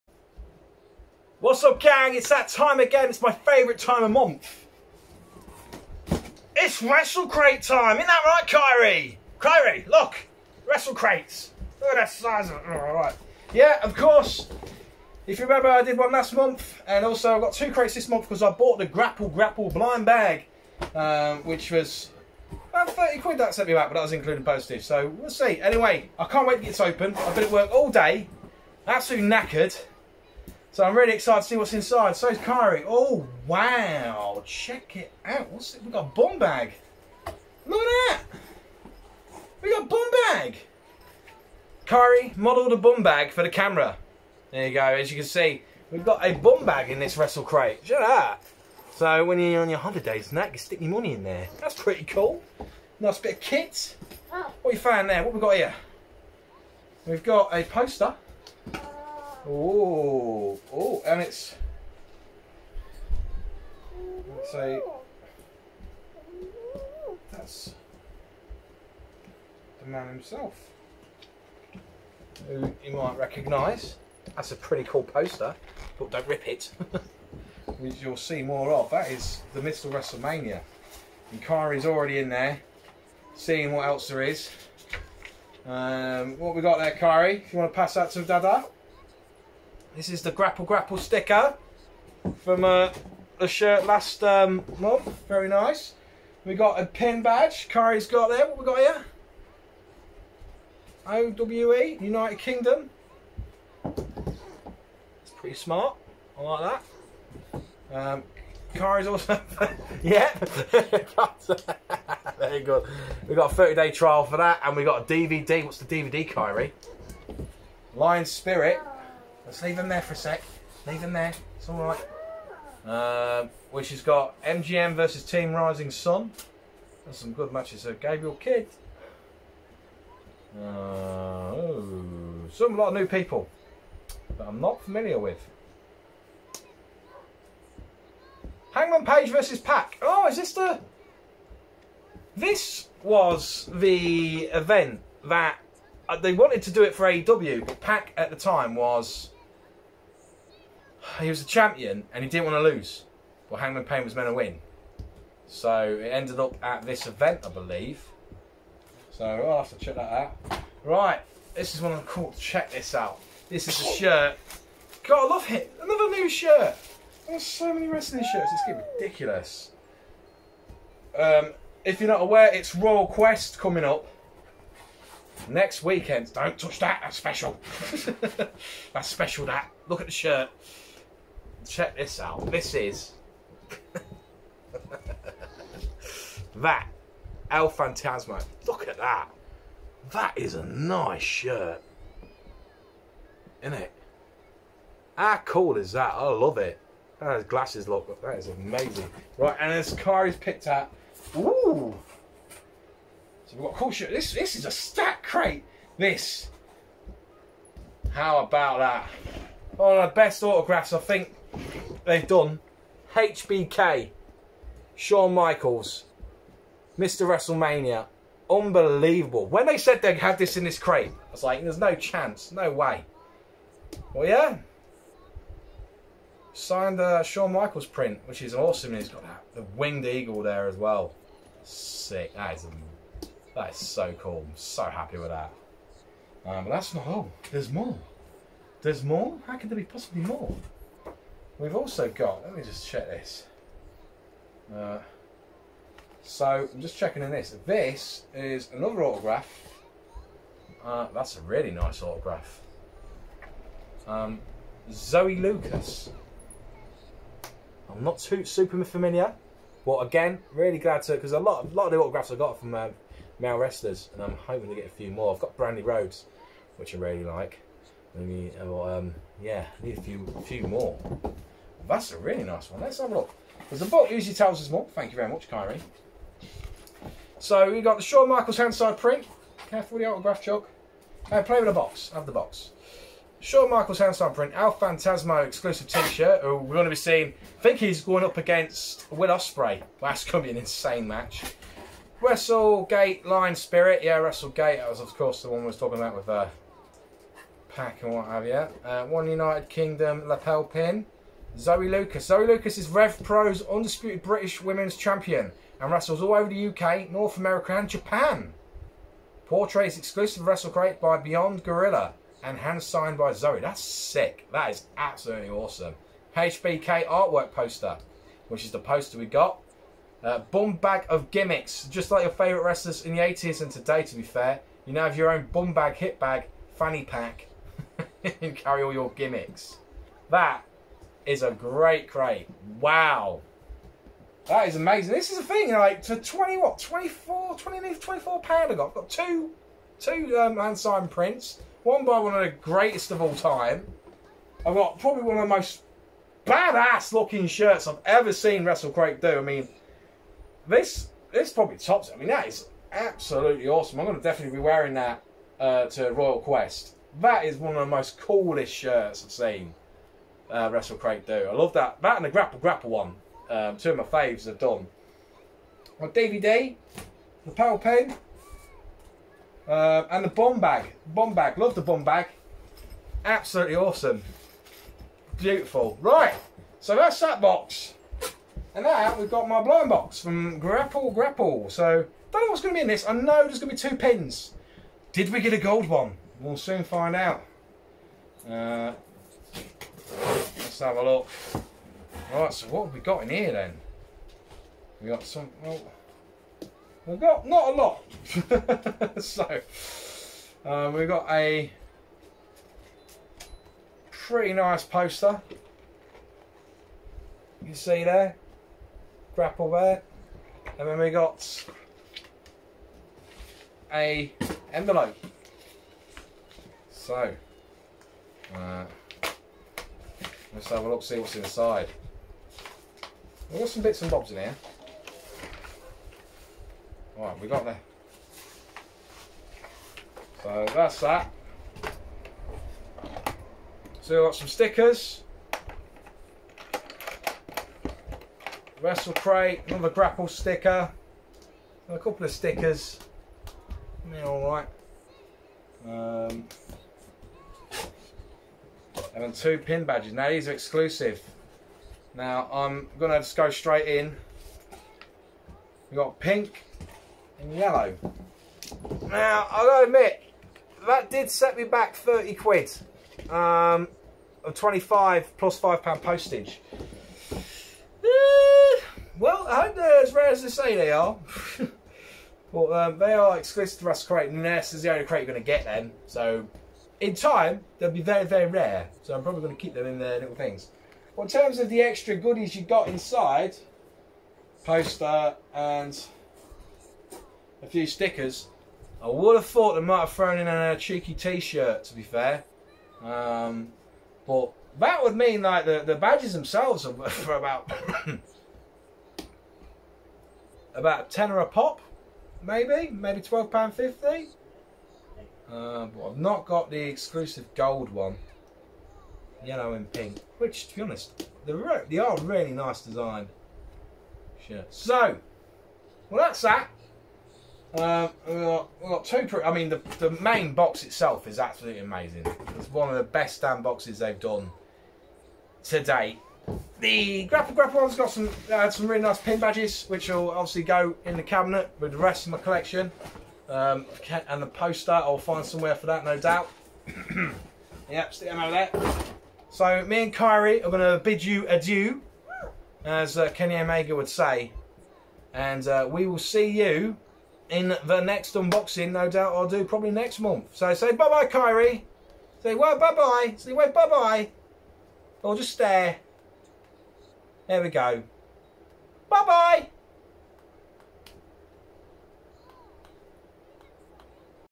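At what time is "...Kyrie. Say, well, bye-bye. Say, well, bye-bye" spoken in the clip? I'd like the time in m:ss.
9:11.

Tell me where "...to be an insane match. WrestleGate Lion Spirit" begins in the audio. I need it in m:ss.
4:50.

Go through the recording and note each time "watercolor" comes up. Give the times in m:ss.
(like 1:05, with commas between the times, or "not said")
not said.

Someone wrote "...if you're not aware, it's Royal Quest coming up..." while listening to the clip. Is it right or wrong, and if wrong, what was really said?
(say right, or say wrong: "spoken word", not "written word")
right.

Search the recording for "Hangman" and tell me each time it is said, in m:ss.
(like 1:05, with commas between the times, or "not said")
2:18, 2:33.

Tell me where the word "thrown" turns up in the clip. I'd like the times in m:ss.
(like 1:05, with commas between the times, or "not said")
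8:10.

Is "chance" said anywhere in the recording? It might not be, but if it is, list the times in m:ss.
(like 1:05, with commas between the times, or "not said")
3:41.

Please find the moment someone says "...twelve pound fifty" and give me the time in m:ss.
8:23.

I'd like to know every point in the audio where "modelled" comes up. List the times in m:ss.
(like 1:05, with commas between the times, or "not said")
0:42.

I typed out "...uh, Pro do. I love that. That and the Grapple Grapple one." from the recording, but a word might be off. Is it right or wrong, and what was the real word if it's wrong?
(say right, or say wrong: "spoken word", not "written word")
wrong: "Wrestle", not "Pro".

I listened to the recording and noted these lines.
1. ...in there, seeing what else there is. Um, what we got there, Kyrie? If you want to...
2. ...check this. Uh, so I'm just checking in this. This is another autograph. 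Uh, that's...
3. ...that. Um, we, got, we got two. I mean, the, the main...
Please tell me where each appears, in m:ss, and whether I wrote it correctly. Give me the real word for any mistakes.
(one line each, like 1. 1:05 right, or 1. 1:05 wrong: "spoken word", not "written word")
1. 1:22 right
2. 4:02 right
3. 8:36 right.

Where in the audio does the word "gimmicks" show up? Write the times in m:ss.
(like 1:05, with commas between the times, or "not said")
5:21, 5:29.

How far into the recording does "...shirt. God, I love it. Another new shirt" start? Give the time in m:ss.
2:43.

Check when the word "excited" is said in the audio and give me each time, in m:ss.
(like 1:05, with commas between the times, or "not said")
0:31.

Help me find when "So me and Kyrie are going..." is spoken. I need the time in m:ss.
8:59.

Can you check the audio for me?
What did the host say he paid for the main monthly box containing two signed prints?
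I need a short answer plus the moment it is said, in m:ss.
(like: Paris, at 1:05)
24 pounds, at 5:36.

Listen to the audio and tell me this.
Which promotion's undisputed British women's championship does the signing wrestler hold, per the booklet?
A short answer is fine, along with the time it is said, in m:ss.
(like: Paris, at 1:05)
Rev Pro, at 5:02.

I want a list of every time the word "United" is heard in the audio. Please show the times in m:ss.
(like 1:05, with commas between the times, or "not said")
1:41, 4:59.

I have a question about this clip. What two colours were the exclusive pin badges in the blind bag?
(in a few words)
Pink and yellow.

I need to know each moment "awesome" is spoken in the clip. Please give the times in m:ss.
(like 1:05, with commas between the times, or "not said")
3:48, 5:15, 5:53, 6:13.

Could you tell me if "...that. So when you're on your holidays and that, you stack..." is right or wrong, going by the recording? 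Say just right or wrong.
wrong.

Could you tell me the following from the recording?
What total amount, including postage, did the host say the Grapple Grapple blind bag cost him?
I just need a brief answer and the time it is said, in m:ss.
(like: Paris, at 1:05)
30 quid, at 0:22.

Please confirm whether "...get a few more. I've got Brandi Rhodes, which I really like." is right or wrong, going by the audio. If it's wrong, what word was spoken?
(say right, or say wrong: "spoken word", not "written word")
right.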